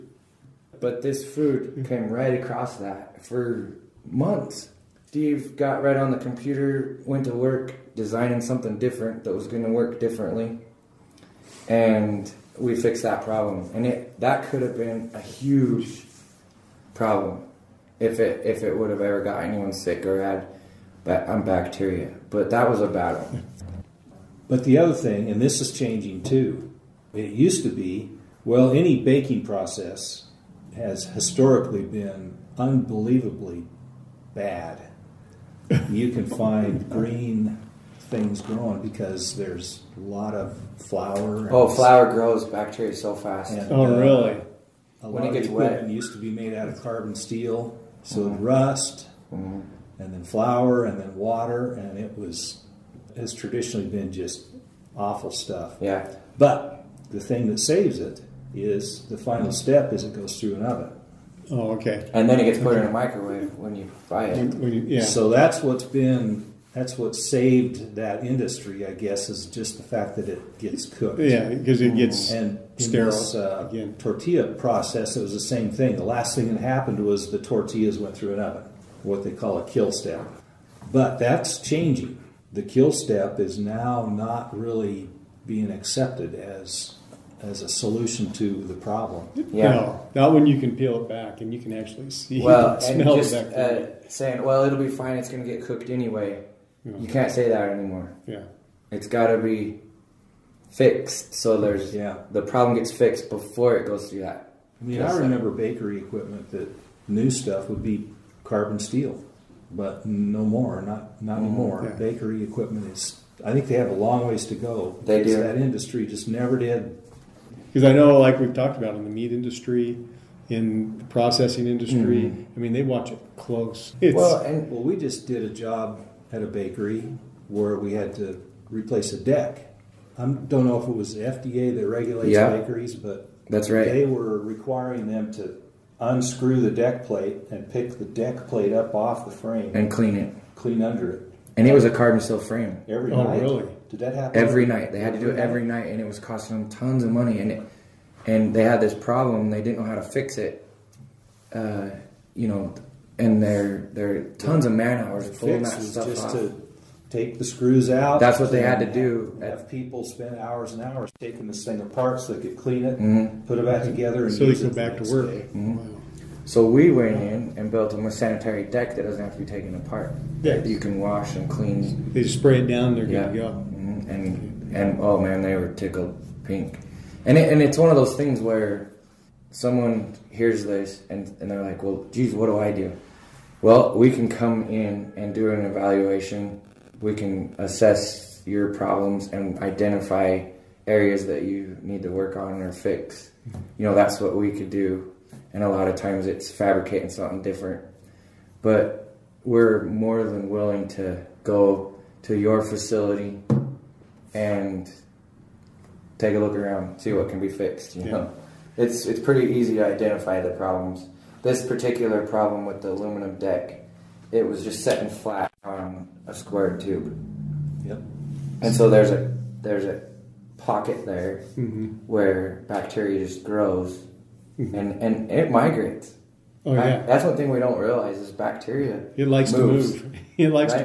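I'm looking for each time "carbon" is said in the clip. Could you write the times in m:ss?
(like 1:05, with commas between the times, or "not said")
0:46, 1:48, 2:21.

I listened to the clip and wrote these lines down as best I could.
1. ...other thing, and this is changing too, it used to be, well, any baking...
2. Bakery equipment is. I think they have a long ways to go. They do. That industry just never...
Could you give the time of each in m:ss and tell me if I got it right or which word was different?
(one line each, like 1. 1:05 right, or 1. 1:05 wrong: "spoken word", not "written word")
1. 0:24 right
2. 1:51 right.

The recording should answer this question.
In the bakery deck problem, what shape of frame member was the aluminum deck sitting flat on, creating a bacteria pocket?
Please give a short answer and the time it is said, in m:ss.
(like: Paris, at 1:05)
Square tube, at 3:36.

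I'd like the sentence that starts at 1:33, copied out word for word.
Uh, saying, well, it'll be fine.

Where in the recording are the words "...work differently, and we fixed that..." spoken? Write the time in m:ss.
0:09.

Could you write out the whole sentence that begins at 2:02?
I mean, they watch it close.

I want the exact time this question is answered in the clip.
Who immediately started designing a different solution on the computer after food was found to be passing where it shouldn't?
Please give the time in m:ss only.
0:05.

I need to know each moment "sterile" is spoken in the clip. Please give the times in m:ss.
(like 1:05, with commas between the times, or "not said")
1:12.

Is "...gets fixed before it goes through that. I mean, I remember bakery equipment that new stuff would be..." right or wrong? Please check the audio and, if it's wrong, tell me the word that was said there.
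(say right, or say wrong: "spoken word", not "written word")
right.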